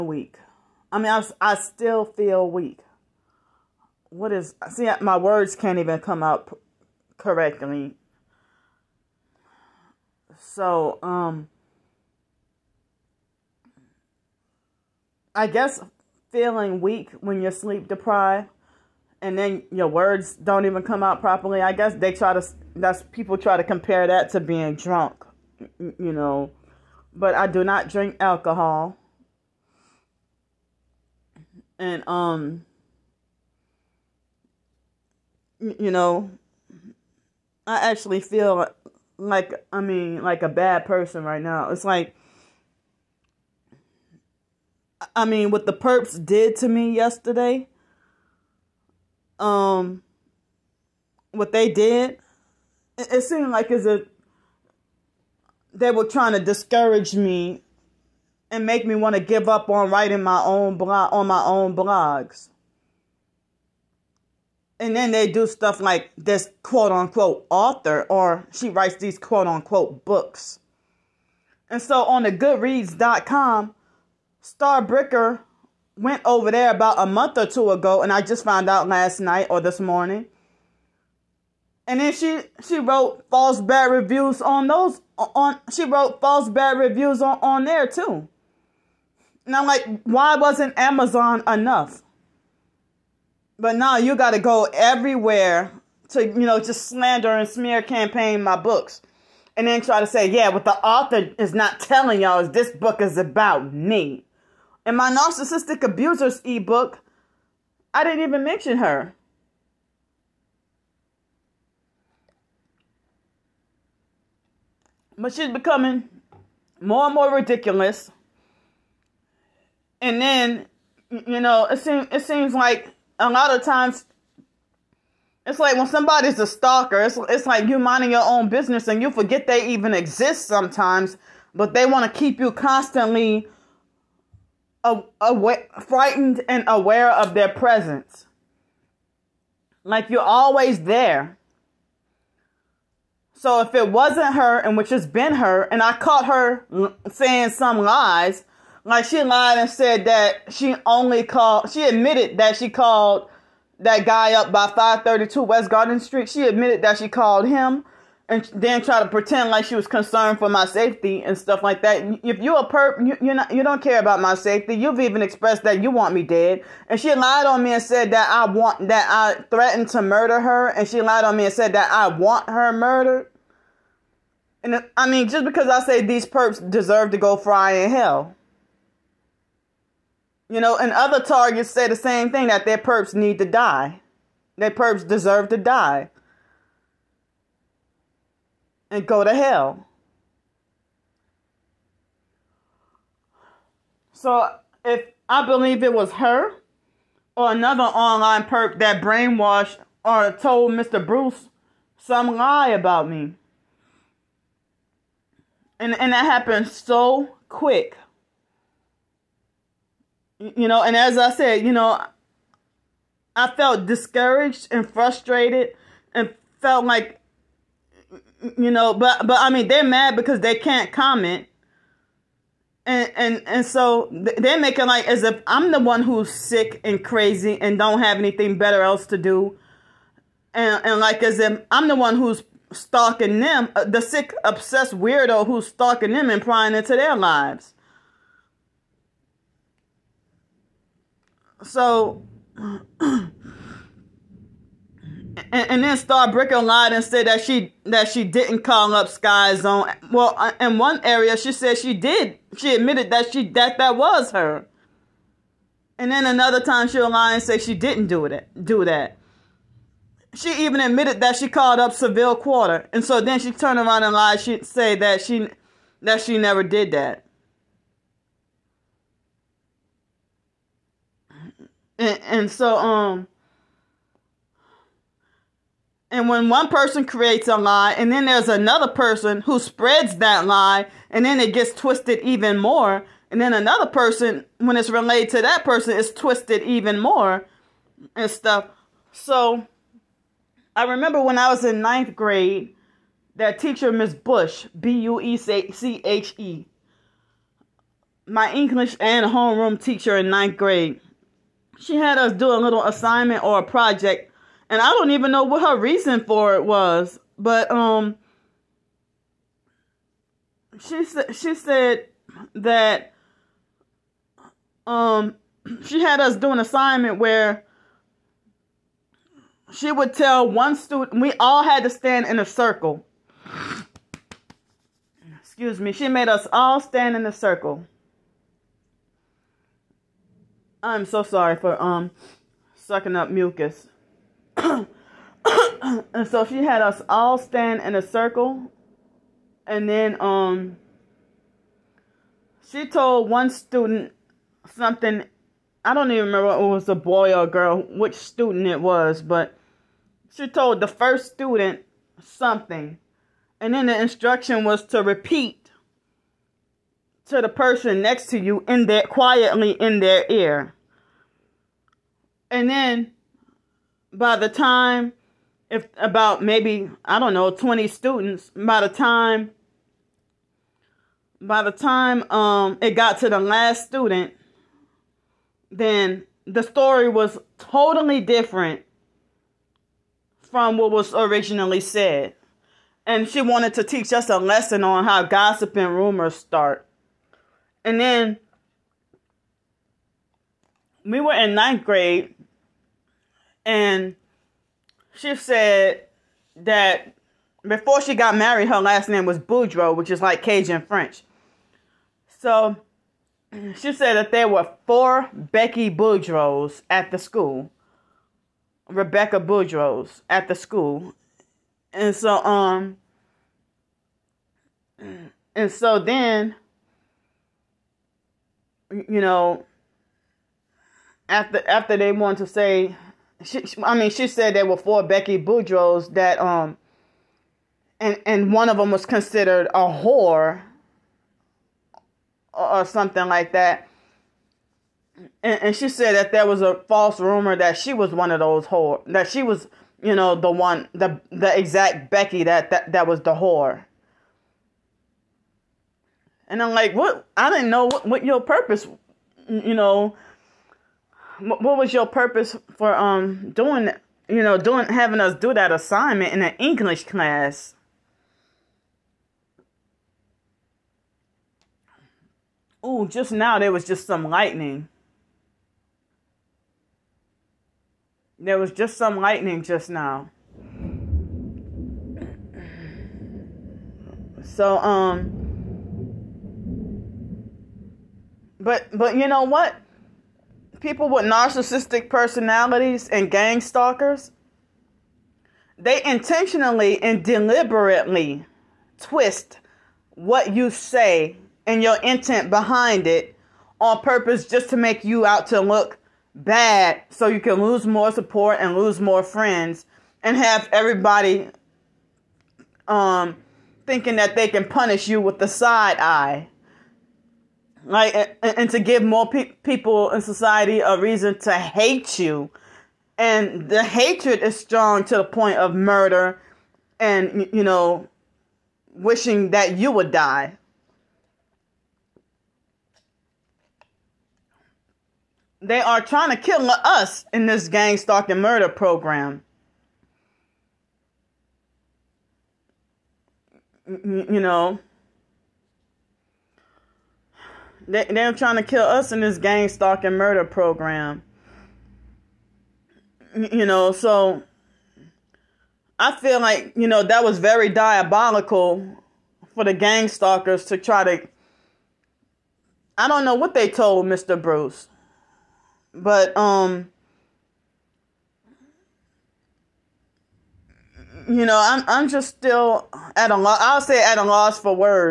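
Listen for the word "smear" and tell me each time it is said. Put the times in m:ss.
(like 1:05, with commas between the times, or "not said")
1:37.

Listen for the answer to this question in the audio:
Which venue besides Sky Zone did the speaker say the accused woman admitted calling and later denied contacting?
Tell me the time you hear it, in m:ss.
4:21.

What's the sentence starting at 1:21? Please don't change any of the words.
And then she she wrote false bad reviews on those on she wrote false bad reviews on, on there too.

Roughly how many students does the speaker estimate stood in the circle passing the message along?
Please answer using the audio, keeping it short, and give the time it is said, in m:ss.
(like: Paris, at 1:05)
20, at 6:07.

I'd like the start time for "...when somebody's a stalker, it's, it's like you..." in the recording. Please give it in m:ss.
2:05.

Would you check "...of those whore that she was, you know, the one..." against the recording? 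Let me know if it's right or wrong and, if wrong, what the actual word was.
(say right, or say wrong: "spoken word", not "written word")
right.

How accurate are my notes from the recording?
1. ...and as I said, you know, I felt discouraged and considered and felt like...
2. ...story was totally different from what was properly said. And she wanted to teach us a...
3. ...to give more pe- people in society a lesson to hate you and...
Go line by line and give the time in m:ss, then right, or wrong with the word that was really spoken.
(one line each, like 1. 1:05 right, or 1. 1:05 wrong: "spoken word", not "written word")
1. 3:30 wrong: "frustrated", not "considered"
2. 6:16 wrong: "originally", not "properly"
3. 8:28 wrong: "reason", not "lesson".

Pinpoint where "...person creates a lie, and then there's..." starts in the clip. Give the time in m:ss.
4:36.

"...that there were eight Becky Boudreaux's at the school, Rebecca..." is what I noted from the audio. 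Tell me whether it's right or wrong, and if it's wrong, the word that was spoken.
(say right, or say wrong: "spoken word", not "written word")
wrong: "four", not "eight".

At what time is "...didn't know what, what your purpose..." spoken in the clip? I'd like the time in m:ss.
7:27.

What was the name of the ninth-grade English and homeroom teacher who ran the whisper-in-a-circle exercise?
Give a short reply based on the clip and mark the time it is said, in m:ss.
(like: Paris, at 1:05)
Miss Bush, at 4:53.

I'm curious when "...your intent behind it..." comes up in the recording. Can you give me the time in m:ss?
8:11.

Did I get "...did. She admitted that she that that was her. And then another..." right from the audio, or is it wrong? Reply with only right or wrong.
right.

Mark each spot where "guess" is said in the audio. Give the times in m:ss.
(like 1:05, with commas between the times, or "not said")
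0:15, 0:21.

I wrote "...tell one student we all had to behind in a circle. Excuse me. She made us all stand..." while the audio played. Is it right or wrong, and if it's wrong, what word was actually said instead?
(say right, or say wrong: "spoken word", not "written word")
wrong: "stand", not "behind".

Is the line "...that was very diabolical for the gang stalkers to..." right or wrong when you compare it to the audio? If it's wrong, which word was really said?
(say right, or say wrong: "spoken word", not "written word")
right.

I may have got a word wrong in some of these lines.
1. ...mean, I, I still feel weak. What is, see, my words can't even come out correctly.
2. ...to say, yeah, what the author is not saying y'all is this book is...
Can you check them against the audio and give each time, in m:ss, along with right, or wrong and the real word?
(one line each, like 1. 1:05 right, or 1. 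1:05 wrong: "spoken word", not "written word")
1. 0:00 right
2. 1:40 wrong: "telling", not "saying".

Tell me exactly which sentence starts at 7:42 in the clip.
Ooh, just now there was just some lightning.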